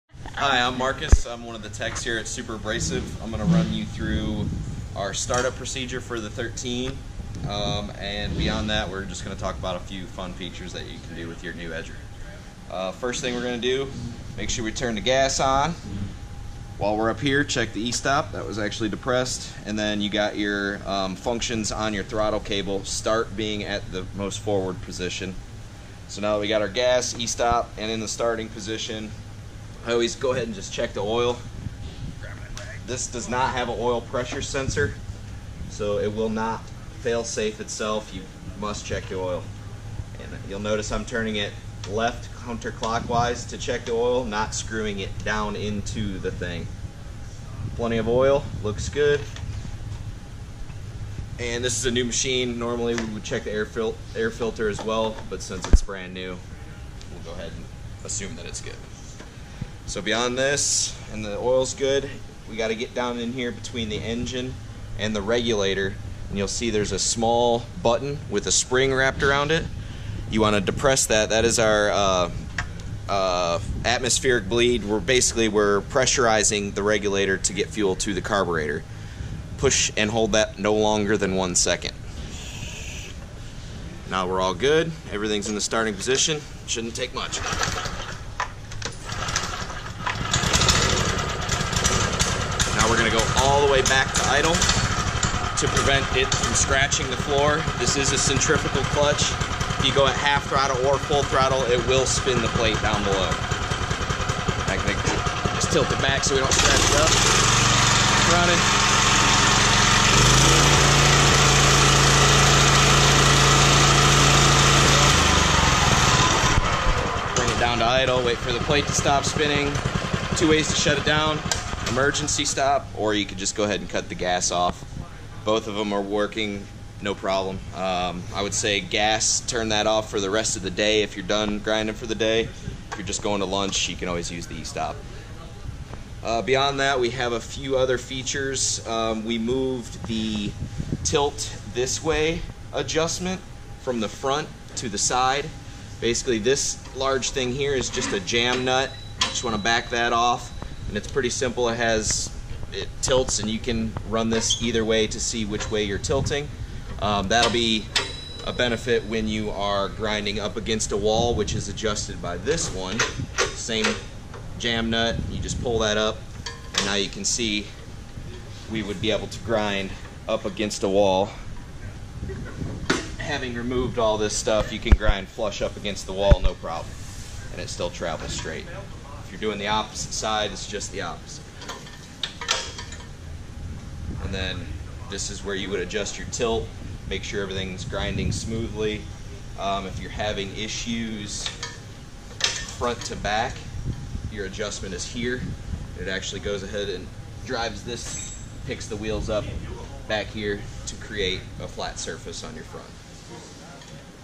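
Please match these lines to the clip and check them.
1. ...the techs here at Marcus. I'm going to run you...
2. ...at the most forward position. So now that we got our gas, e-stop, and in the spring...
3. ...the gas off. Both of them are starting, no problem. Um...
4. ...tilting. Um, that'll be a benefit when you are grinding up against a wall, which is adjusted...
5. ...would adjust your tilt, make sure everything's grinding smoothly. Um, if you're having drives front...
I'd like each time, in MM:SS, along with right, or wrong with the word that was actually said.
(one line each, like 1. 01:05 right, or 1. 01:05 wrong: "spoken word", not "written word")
1. 00:01 wrong: "Superabrasive", not "Marcus"
2. 00:23 wrong: "starting", not "spring"
3. 02:04 wrong: "working", not "starting"
4. 02:35 right
5. 03:05 wrong: "issues", not "drives".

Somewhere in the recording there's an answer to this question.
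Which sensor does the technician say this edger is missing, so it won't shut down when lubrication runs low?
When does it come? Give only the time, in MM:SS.
00:33.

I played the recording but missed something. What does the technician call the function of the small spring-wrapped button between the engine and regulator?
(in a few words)
Atmospheric bleed.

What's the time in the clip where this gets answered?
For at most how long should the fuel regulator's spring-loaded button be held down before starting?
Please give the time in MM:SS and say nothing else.
01:21.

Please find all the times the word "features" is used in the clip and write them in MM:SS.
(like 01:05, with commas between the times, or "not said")
00:10, 02:17.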